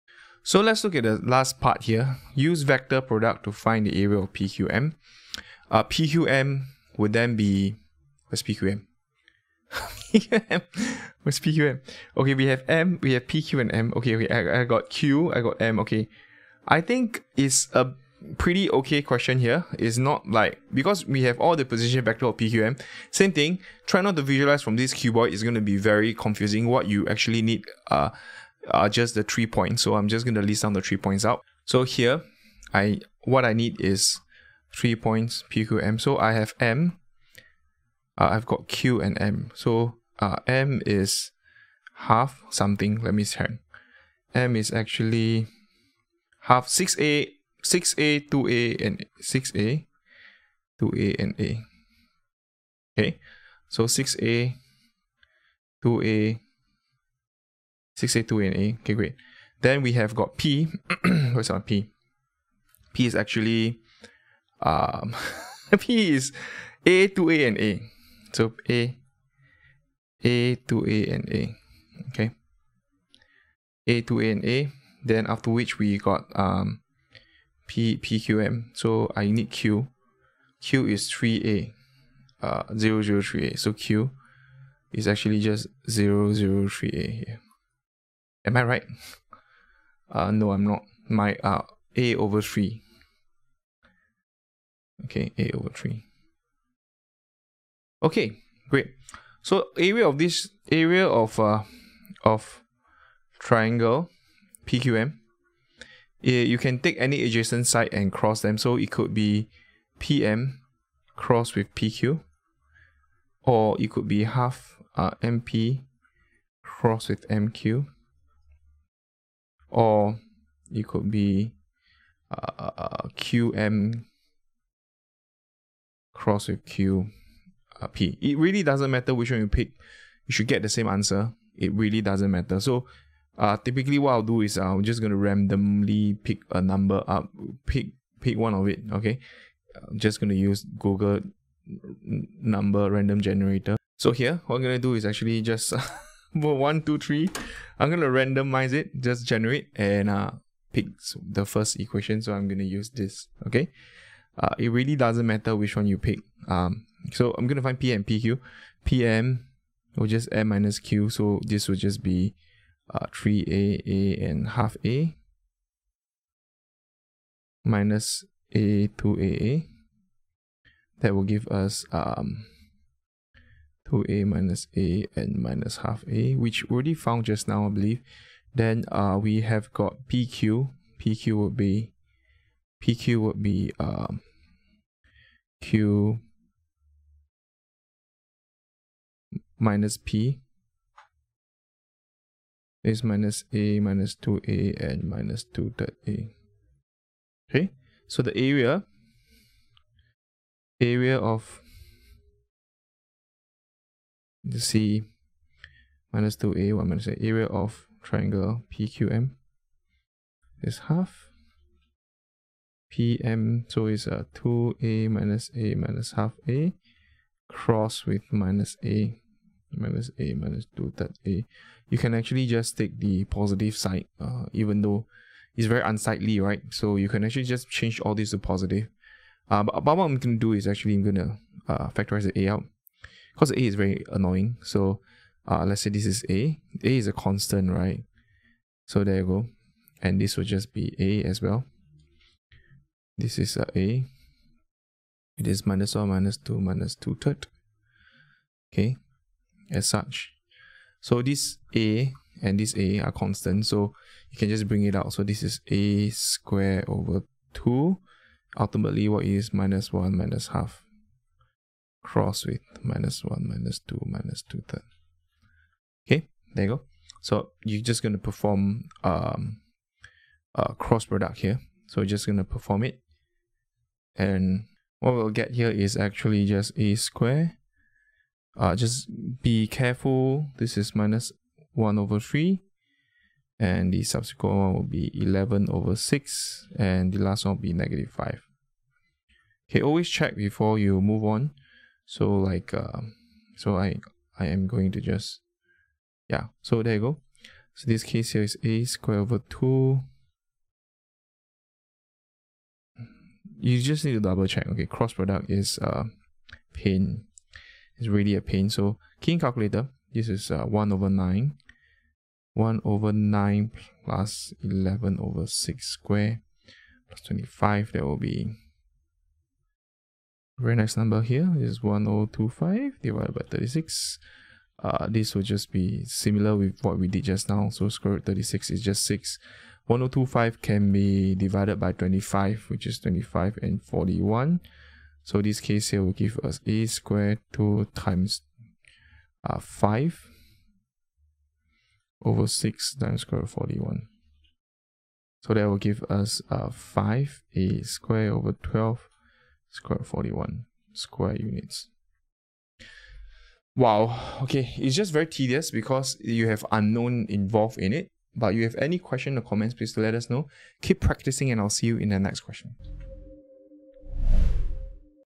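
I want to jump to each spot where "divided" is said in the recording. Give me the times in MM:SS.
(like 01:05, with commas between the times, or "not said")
05:23, 05:31.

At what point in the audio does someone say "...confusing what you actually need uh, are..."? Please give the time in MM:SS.
00:26.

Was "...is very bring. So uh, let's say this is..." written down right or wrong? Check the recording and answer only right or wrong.
wrong.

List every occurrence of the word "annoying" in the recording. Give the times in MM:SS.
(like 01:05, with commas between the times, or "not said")
03:54.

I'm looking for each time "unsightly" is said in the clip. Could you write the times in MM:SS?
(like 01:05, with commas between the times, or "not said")
03:45.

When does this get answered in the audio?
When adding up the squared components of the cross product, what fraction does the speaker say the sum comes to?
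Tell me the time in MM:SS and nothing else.
05:21.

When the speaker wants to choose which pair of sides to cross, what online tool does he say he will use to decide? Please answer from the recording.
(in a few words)
Google number random generator.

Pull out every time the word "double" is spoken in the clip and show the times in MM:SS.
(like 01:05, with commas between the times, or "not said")
05:04.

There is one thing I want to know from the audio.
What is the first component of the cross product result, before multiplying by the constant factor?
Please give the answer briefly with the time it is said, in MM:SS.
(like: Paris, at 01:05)
-1/3, at 04:40.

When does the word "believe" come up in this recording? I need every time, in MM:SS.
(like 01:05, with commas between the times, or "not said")
02:57.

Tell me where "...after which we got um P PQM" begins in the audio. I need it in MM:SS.
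01:15.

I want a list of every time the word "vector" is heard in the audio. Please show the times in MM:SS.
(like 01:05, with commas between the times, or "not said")
00:02, 00:22.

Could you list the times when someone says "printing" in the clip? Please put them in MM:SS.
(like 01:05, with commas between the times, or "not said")
not said.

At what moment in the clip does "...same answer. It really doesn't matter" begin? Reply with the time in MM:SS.
02:10.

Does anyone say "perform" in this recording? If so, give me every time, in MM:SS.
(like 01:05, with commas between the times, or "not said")
04:28, 04:32.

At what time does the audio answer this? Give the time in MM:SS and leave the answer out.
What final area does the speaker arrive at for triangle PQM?
05:46.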